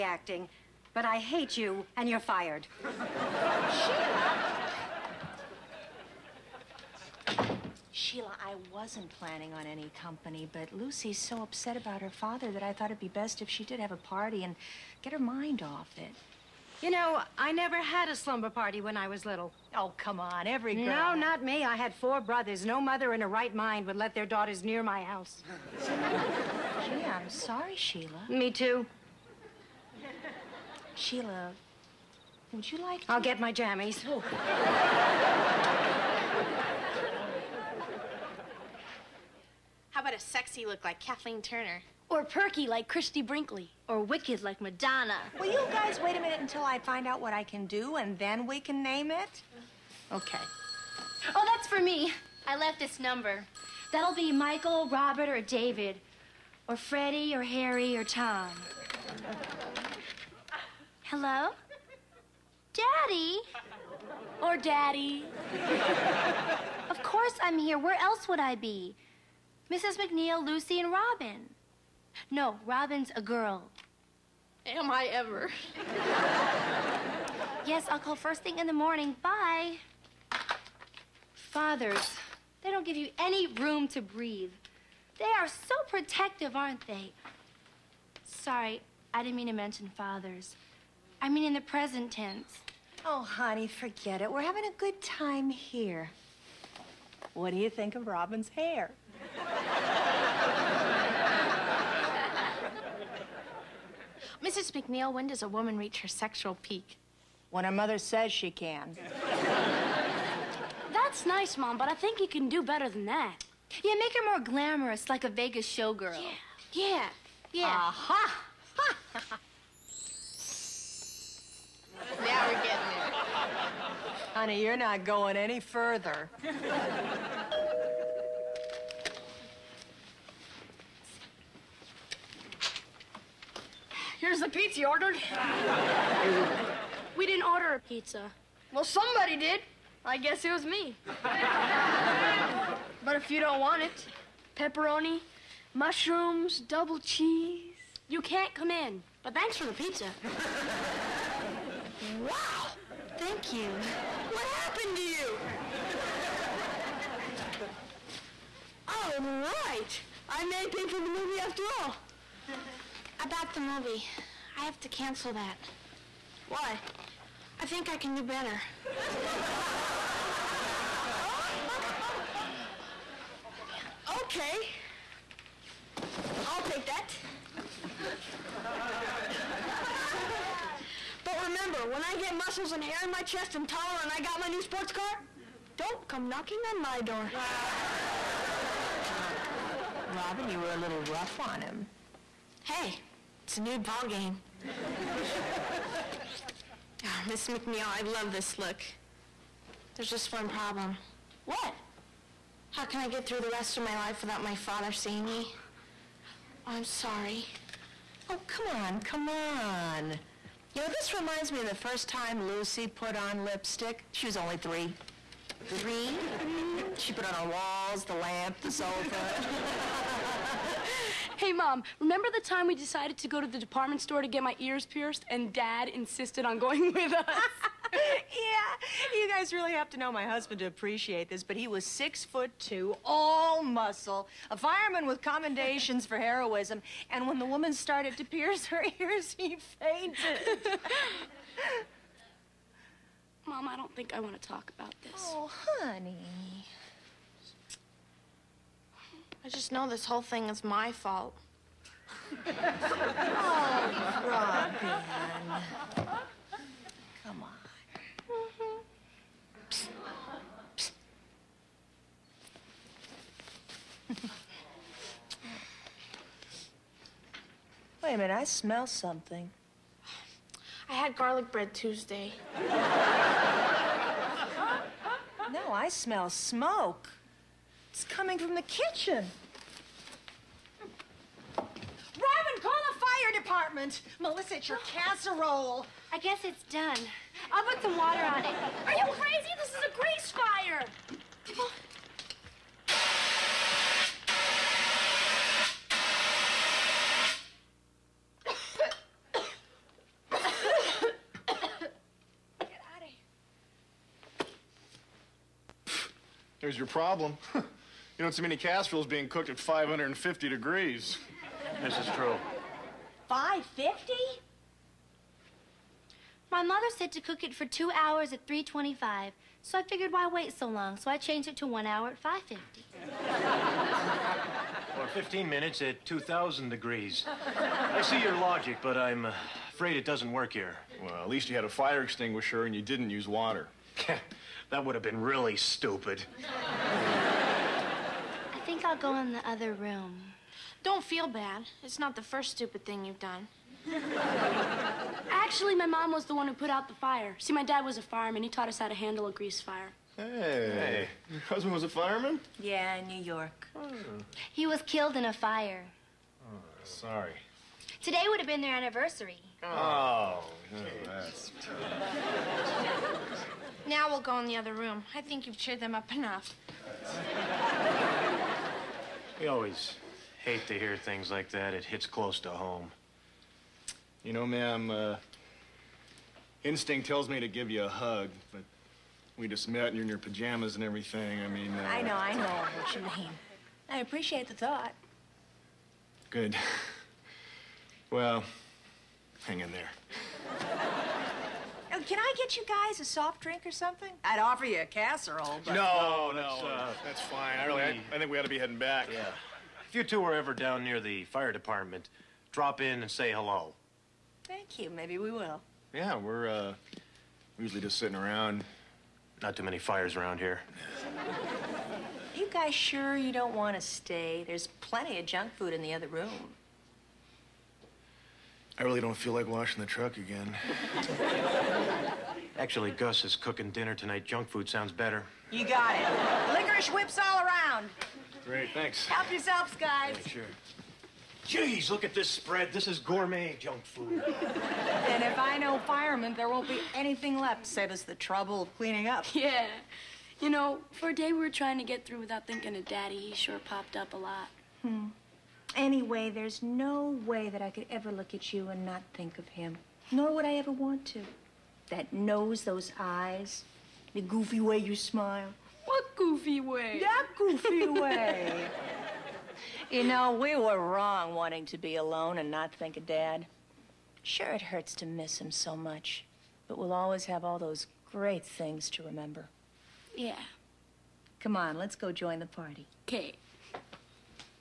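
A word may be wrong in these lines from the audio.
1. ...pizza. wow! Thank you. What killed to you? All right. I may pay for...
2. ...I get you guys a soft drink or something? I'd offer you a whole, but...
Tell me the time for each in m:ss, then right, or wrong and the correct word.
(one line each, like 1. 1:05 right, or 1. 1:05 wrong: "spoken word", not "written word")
1. 2:29 wrong: "happened", not "killed"
2. 6:32 wrong: "casserole", not "whole".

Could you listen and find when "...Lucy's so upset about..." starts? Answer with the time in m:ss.
0:10.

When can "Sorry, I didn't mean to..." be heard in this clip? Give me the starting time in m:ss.
1:28.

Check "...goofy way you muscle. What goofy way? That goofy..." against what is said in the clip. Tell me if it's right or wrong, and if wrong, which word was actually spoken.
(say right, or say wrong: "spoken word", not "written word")
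wrong: "smile", not "muscle".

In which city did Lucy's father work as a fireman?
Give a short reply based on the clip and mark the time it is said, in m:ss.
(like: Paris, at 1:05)
New York, at 5:53.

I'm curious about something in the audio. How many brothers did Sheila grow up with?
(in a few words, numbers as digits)
4.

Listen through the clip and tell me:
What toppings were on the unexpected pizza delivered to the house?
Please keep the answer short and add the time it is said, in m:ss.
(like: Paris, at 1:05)
pepperoni, mushrooms, double cheese, at 2:24.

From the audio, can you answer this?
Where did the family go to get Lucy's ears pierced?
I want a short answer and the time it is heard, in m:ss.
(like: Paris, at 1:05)
department store, at 3:43.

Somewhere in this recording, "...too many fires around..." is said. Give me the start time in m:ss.
6:49.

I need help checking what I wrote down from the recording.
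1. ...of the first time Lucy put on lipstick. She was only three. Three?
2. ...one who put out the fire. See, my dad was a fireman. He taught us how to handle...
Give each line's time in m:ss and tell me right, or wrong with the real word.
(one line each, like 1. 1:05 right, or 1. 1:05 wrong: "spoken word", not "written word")
1. 3:31 right
2. 5:46 right.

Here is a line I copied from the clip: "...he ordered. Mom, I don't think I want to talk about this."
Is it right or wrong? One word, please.
wrong.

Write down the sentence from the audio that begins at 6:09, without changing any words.
We always hate to hear things like that.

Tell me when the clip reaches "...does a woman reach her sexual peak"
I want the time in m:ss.
1:45.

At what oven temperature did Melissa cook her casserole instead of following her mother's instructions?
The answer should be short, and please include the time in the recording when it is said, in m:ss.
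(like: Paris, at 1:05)
550 degrees, at 5:09.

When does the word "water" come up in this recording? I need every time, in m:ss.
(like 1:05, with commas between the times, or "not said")
4:47, 5:33.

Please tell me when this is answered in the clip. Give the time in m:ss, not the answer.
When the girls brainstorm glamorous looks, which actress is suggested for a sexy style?
0:40.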